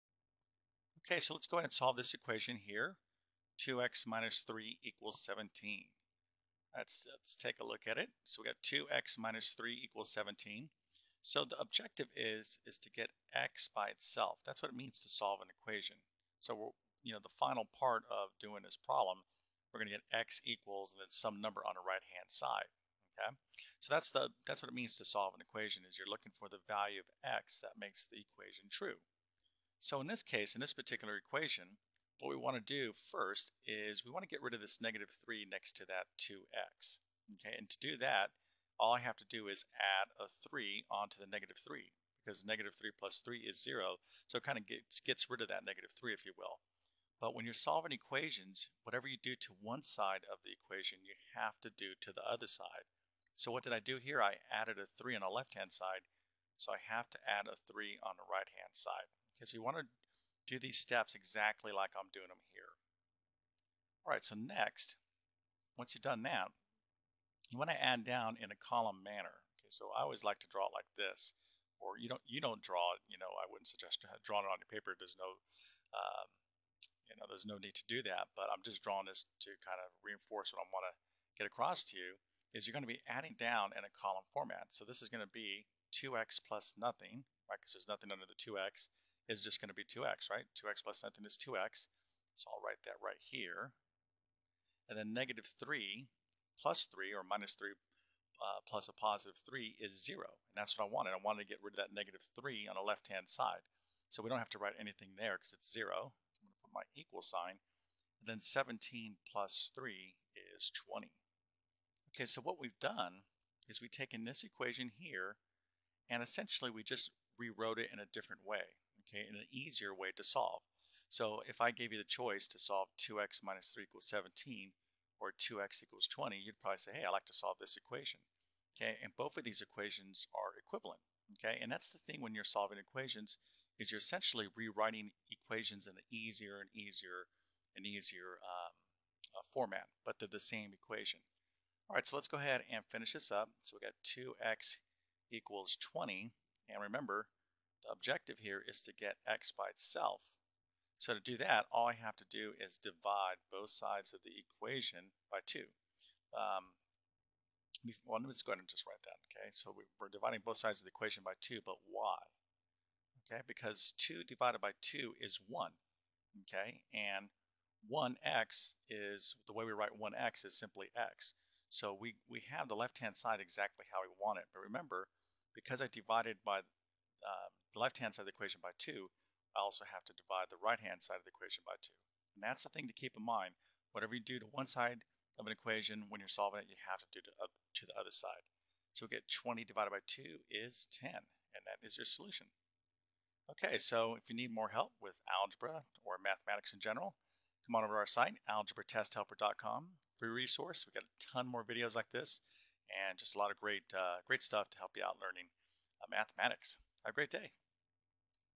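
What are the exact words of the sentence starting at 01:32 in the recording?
So I'll write that right here.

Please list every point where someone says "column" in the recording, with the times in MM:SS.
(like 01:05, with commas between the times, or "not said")
01:08, 01:23.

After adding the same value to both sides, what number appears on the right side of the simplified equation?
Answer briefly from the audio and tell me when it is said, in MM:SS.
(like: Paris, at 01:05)
20, at 01:48.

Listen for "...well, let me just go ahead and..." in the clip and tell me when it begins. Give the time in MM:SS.
02:38.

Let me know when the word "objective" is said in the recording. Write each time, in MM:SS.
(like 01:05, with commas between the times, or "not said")
00:11, 02:27.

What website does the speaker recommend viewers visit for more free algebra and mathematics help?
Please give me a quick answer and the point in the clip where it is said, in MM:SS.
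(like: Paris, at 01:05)
algebratesthelper.com, at 03:18.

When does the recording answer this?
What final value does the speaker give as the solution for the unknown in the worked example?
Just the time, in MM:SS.
03:09.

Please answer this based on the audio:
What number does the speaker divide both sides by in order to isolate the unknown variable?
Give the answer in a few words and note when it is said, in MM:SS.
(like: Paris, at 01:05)
2, at 02:32.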